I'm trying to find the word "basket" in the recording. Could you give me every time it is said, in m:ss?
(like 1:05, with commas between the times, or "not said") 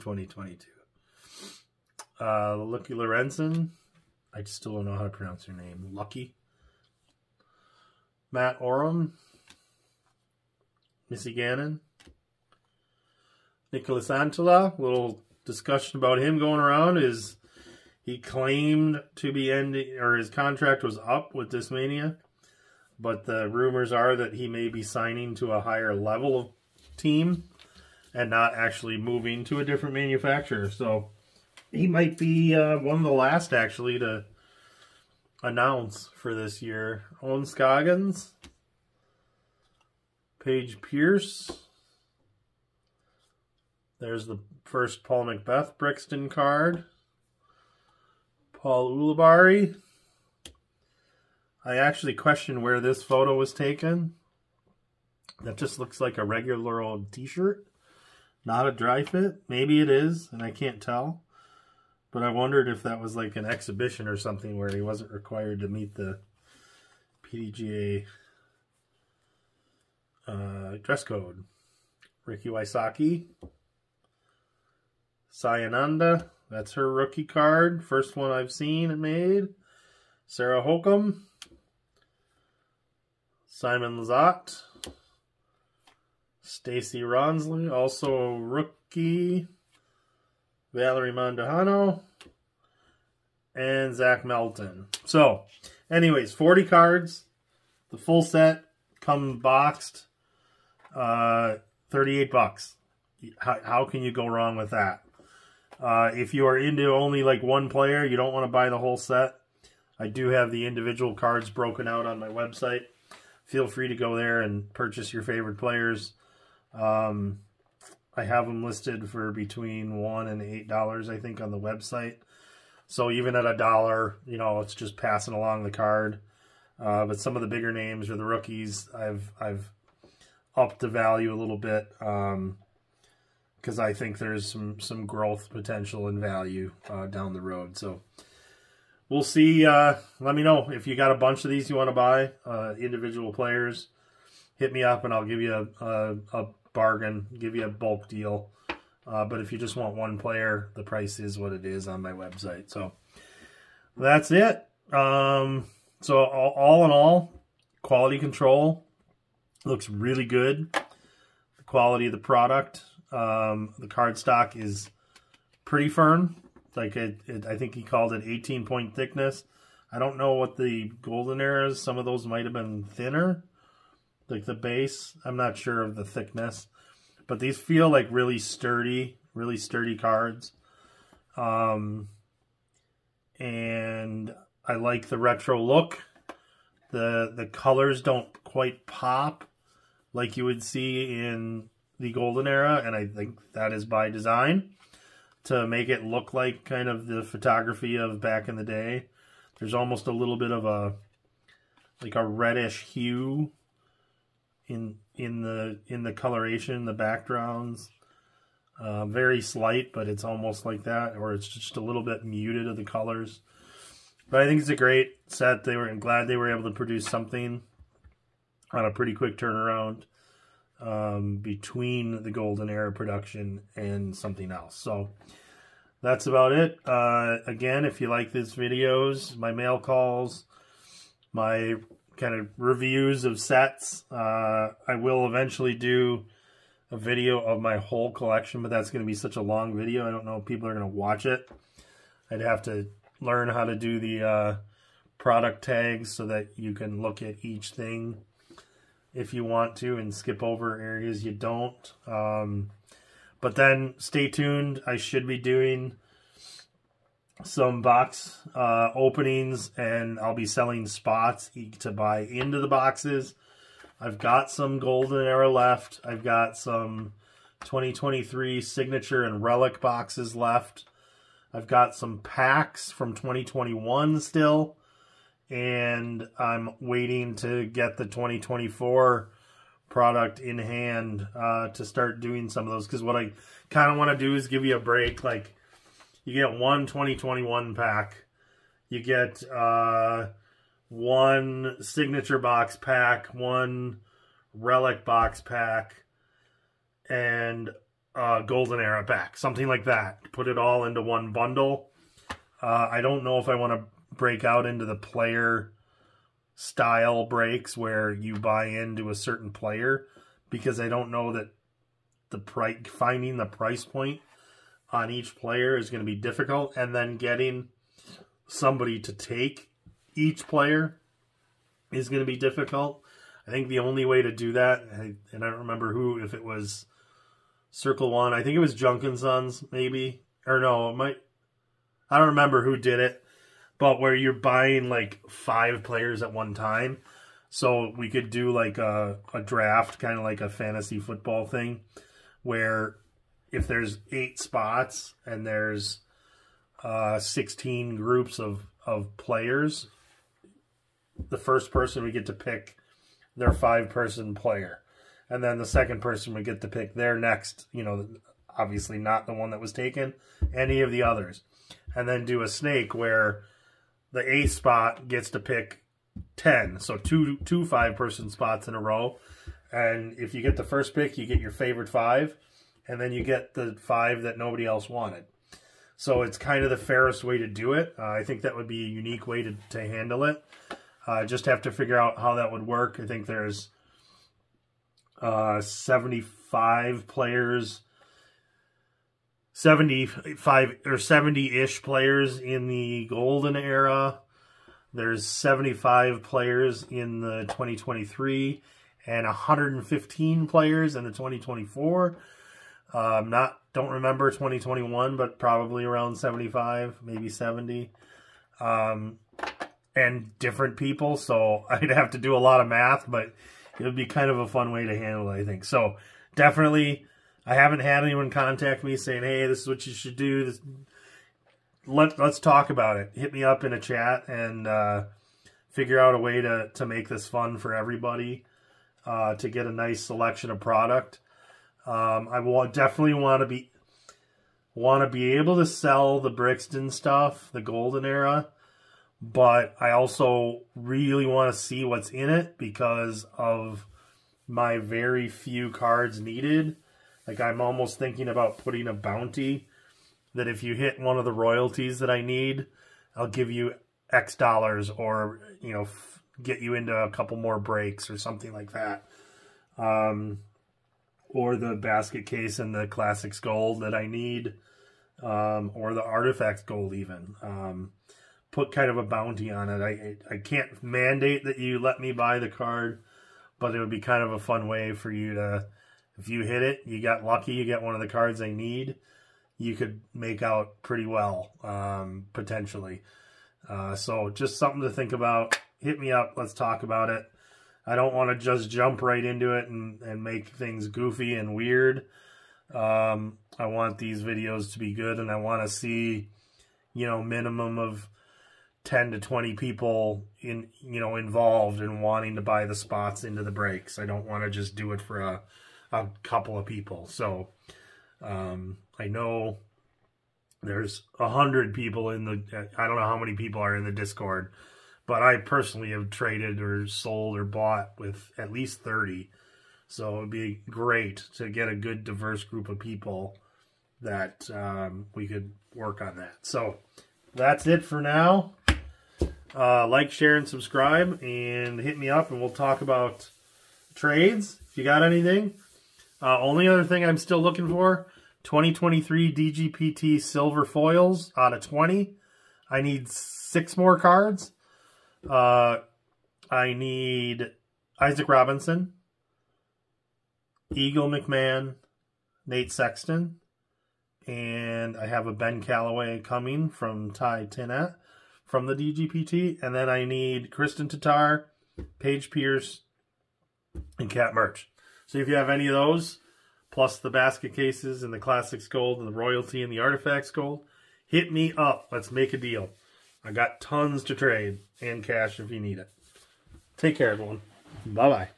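7:41, 9:27.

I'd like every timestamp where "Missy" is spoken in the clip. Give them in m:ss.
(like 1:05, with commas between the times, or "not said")
0:11.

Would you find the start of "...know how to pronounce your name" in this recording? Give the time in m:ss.
0:04.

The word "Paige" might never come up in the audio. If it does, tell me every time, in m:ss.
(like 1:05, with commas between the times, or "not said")
0:40, 9:21.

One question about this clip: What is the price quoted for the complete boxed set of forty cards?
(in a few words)
$38.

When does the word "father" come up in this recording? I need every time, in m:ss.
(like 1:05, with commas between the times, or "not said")
not said.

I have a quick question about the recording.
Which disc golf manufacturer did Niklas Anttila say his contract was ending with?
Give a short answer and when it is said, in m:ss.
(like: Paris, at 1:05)
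Discmania, at 0:21.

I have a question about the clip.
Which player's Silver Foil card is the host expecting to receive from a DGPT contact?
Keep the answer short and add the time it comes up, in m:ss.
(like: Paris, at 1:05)
Ben Callaway, at 9:15.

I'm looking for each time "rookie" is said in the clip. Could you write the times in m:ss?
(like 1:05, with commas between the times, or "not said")
1:16, 1:28, 2:08.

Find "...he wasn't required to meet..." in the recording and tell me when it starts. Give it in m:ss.
1:04.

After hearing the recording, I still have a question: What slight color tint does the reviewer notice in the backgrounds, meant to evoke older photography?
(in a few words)
Reddish hue.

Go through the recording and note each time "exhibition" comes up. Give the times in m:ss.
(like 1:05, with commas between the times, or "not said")
1:03.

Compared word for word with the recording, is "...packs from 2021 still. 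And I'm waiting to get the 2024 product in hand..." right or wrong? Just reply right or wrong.
right.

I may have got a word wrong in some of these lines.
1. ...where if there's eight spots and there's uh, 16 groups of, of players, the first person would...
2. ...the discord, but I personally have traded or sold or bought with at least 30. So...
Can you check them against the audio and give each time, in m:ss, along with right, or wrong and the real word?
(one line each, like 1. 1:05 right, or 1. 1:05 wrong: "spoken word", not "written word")
1. 5:42 right
2. 8:33 right.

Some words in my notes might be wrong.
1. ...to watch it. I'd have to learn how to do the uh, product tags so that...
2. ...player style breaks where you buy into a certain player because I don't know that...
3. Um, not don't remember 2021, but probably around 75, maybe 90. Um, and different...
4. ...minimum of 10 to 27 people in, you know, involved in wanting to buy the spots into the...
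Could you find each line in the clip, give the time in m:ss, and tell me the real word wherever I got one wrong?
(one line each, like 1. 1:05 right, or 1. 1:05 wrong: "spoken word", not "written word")
1. 4:00 right
2. 5:04 right
3. 6:42 wrong: "70", not "90"
4. 8:17 wrong: "20", not "27".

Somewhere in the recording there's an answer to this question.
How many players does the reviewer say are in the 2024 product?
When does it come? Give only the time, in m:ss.
6:39.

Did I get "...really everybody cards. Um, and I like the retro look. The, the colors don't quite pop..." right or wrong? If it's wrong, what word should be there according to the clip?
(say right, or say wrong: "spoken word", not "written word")
wrong: "sturdy", not "everybody".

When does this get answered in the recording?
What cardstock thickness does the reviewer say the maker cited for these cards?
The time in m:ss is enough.
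2:48.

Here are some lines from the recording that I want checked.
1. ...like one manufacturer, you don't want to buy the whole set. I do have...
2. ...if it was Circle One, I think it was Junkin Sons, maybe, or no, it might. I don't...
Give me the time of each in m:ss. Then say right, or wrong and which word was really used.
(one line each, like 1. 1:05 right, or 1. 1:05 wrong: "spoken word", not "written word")
1. 1:47 wrong: "player", not "manufacturer"
2. 5:26 right.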